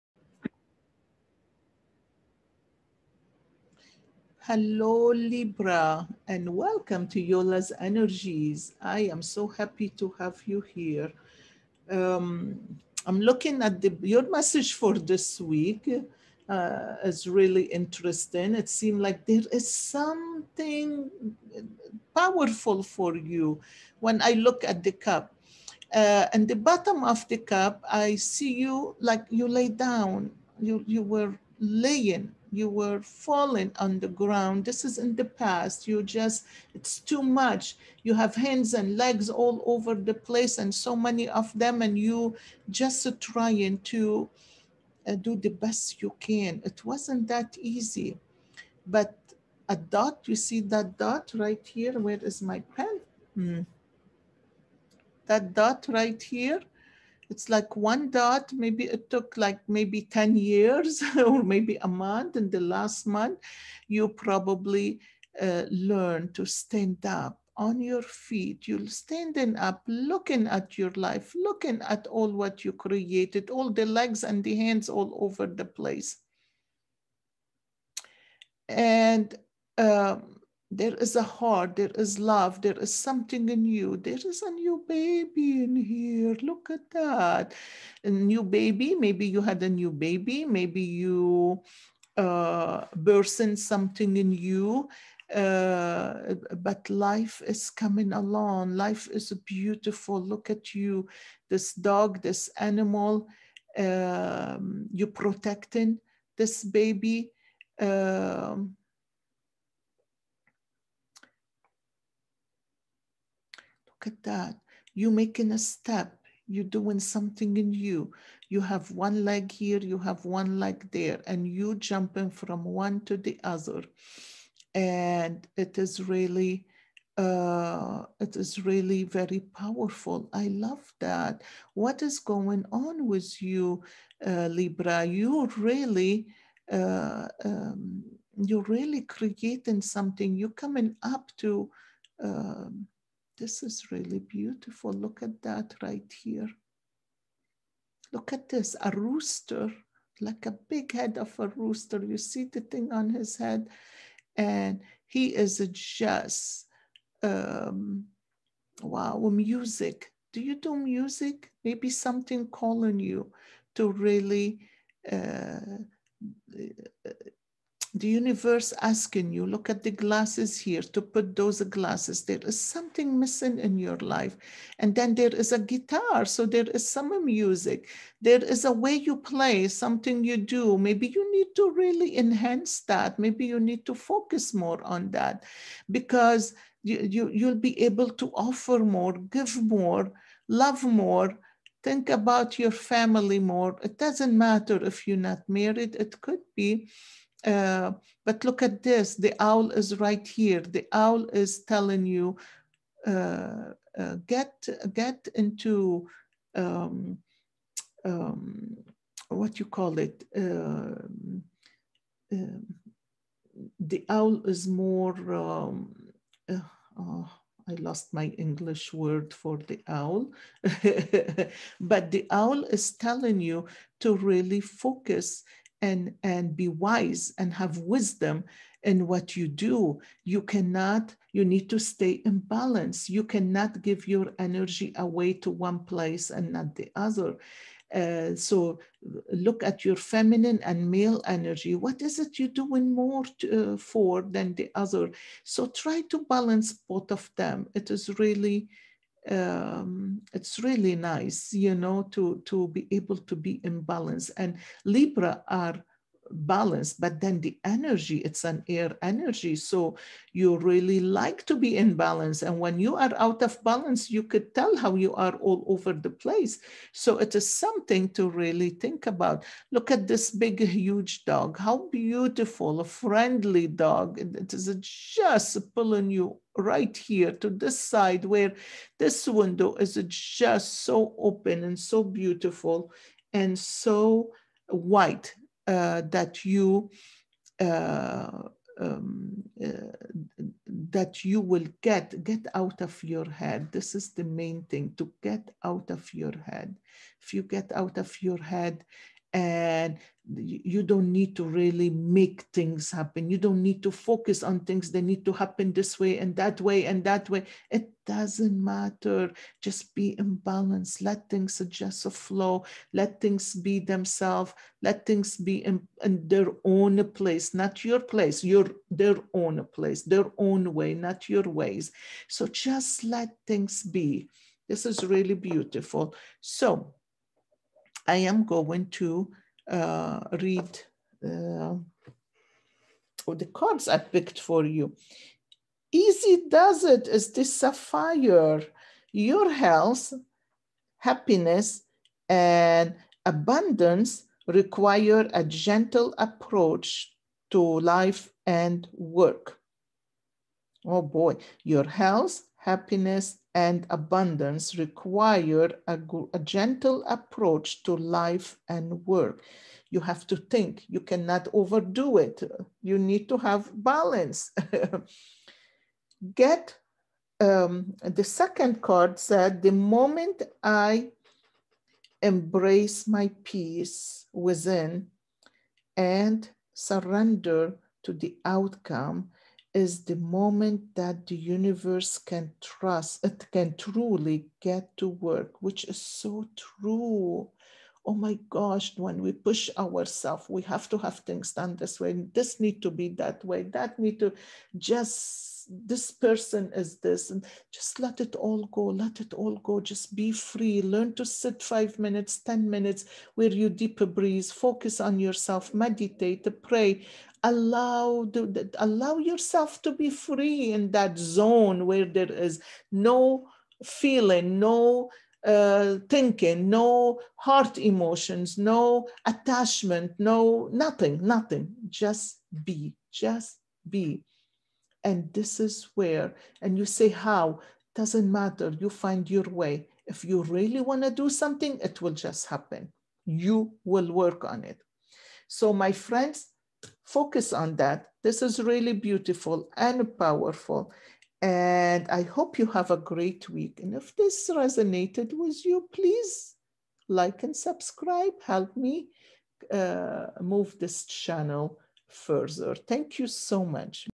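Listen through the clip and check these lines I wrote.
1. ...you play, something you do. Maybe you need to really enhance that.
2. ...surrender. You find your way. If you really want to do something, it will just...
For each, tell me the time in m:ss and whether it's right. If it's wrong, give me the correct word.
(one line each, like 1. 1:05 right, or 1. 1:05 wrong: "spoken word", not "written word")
1. 2:58 right
2. 7:08 wrong: "matter", not "surrender".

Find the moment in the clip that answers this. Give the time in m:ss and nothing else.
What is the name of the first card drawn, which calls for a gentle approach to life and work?
5:35.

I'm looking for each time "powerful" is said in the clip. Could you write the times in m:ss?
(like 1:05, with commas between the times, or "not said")
0:22, 2:09, 7:20.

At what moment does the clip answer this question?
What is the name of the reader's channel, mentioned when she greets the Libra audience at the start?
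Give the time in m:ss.
0:07.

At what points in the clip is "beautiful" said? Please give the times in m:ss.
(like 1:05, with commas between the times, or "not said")
1:39, 2:24, 4:31, 4:42, 5:25, 7:18.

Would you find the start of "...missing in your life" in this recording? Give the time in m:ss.
2:53.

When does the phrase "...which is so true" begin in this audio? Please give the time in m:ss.
6:25.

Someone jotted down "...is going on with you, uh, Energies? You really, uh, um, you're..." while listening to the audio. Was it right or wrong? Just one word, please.
wrong.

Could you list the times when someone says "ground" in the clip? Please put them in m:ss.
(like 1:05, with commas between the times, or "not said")
0:34.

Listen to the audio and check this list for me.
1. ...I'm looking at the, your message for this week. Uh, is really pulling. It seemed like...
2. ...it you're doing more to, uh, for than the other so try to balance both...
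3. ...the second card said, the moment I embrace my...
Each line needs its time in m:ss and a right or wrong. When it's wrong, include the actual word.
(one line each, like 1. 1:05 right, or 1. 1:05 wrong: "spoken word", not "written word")
1. 0:13 wrong: "interesting", not "pulling"
2. 4:02 right
3. 6:08 right.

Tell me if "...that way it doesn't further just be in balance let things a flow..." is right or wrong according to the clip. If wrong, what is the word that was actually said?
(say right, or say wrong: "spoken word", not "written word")
wrong: "matter", not "further".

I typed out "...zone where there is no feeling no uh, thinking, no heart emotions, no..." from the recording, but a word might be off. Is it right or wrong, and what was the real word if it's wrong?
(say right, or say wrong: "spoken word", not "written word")
right.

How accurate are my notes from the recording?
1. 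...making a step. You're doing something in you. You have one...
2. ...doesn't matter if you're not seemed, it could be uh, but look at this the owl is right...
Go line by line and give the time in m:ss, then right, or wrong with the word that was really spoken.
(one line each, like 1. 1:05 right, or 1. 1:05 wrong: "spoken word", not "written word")
1. 1:55 right
2. 3:13 wrong: "married", not "seemed".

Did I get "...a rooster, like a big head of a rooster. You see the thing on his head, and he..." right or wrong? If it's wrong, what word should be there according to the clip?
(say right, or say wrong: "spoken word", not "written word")
right.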